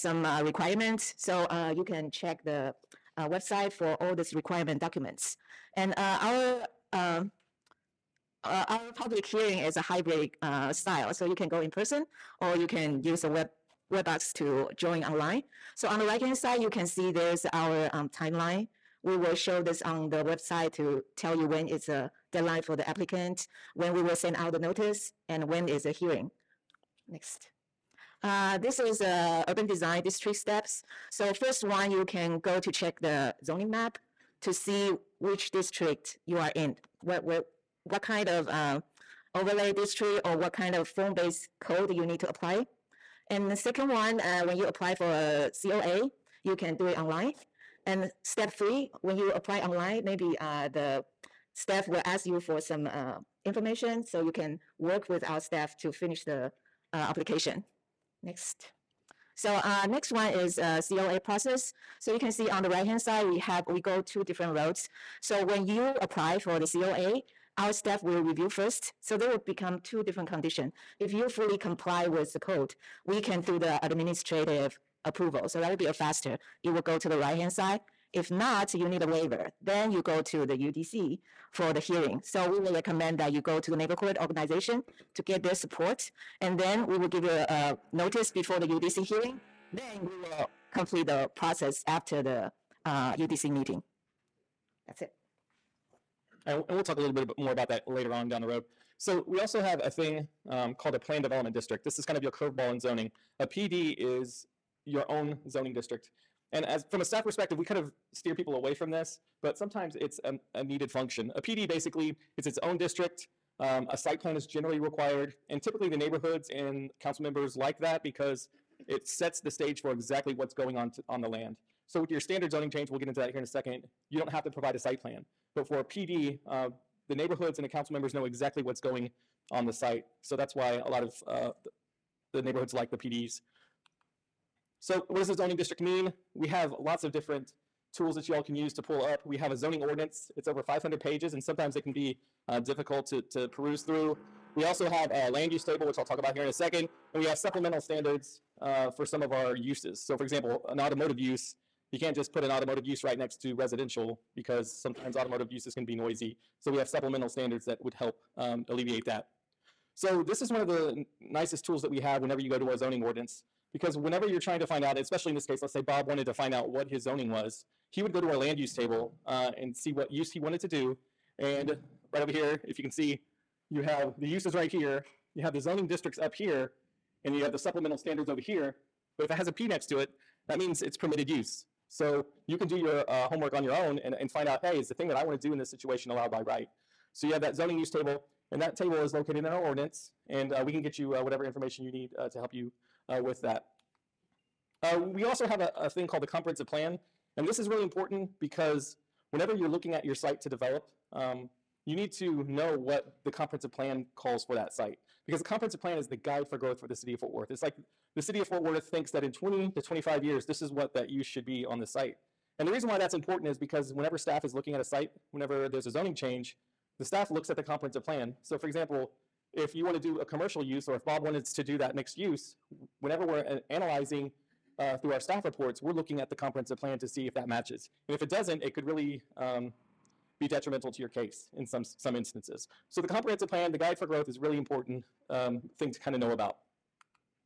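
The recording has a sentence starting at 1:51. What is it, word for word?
A PD basically is its own district.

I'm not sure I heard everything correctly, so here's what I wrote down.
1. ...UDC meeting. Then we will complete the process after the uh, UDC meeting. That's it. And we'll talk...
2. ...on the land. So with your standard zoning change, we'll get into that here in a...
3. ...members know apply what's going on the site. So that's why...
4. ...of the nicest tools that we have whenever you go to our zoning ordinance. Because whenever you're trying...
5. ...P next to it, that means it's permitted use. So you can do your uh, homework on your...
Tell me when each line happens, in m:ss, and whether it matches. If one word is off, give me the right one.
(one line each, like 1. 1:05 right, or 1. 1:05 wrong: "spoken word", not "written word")
1. 1:28 wrong: "hearing", not "meeting"
2. 2:01 right
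3. 2:07 wrong: "exactly", not "apply"
4. 2:40 right
5. 2:59 right.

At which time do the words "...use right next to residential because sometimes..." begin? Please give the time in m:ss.
2:32.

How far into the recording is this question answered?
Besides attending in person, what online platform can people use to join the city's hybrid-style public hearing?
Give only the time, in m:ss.
0:13.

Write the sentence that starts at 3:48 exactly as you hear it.
And if it doesn't, it could really um, be detrimental to your case in some, some instances.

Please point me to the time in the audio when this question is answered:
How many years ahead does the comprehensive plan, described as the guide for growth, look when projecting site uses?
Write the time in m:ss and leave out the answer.
3:29.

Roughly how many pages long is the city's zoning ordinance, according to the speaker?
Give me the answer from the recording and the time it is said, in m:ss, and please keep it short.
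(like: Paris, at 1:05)
over 500, at 2:20.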